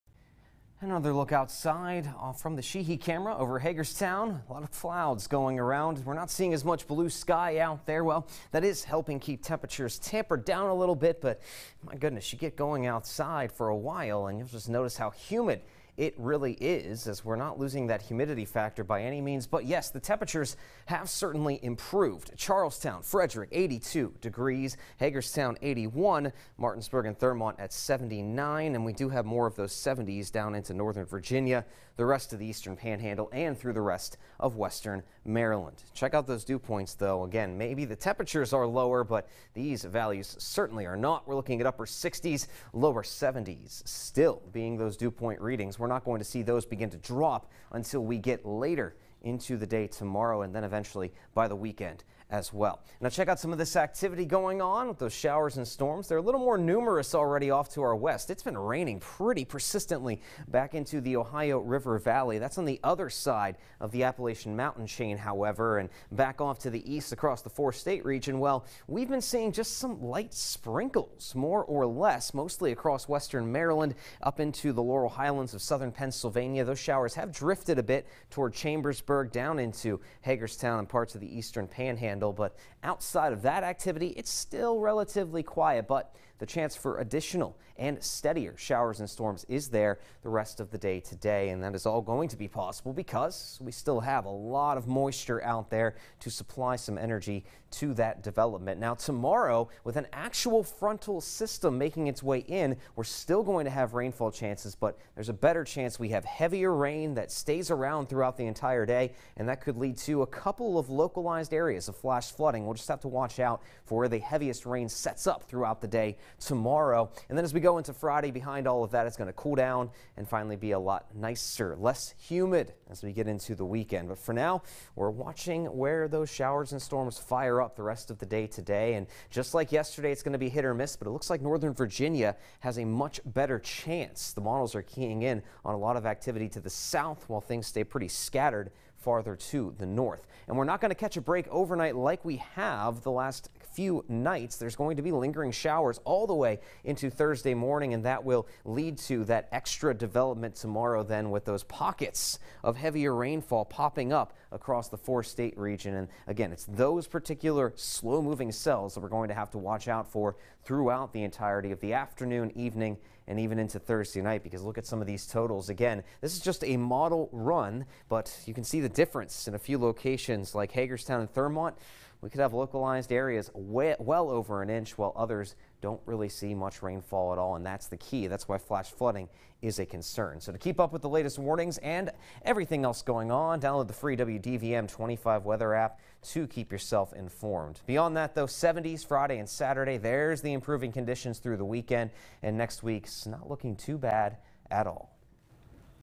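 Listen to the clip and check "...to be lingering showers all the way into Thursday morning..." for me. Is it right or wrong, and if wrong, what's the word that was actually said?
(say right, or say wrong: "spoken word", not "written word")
right.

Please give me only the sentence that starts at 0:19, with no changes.
But yes, the temperatures have certainly improved.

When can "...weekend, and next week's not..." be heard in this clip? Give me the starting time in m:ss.
3:11.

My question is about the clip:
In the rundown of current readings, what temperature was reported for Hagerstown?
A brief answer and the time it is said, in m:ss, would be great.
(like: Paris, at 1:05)
81, at 0:25.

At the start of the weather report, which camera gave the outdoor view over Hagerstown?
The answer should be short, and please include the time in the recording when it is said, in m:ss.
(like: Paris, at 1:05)
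Sheehy camera, at 0:02.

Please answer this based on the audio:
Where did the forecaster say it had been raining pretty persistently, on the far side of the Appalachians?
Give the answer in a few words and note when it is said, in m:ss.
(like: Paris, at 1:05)
Ohio River Valley, at 1:01.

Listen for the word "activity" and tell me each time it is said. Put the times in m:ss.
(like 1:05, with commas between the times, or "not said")
0:53, 1:23, 2:16.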